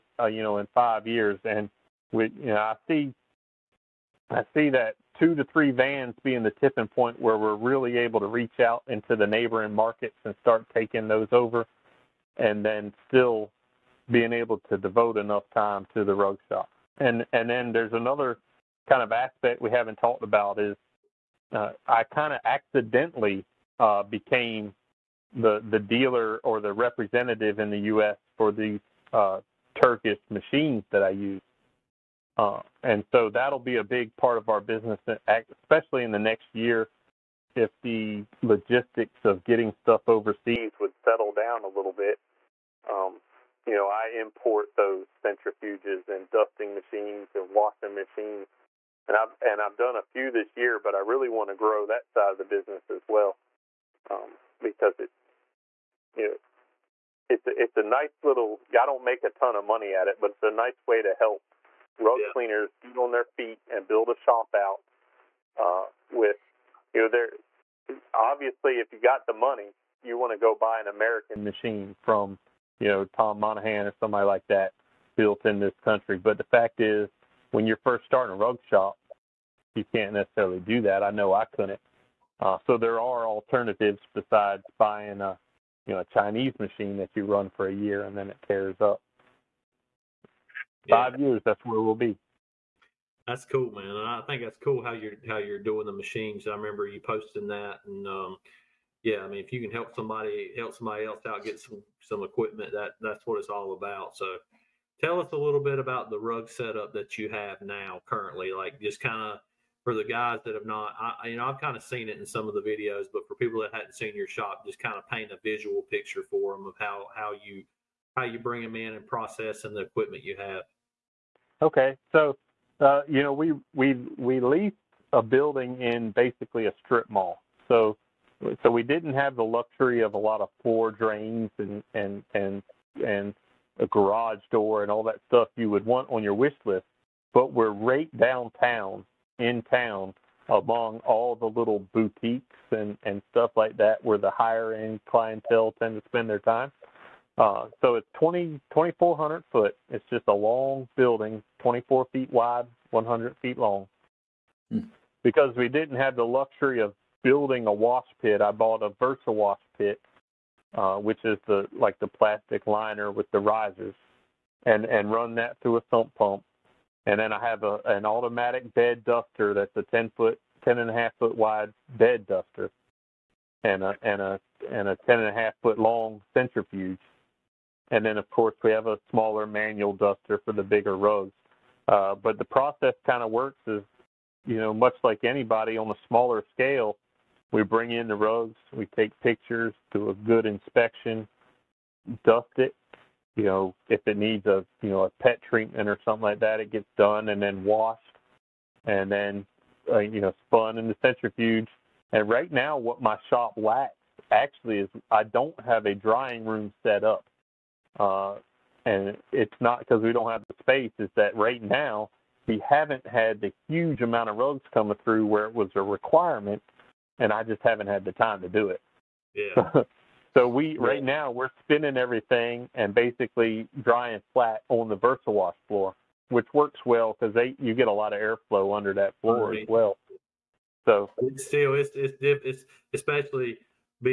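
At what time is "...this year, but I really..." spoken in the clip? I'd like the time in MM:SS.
00:50.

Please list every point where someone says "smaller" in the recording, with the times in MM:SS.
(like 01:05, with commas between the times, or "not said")
02:59, 03:06.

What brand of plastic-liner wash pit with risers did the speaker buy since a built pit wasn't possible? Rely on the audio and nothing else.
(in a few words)
Versa.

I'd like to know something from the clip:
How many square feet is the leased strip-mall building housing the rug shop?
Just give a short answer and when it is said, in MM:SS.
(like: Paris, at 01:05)
2,400, at 02:28.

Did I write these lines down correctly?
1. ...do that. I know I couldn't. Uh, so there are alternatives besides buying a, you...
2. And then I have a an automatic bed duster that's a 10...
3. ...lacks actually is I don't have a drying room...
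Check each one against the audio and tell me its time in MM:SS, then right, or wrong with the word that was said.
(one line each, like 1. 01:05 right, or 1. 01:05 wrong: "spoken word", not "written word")
1. 01:20 right
2. 02:47 right
3. 03:23 right.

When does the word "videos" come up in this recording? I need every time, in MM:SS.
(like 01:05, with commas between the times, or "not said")
01:52.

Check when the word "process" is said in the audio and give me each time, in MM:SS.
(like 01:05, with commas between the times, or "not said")
01:59, 03:02.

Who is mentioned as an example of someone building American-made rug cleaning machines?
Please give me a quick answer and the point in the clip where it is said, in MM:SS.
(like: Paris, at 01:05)
Tom Monahan, at 01:13.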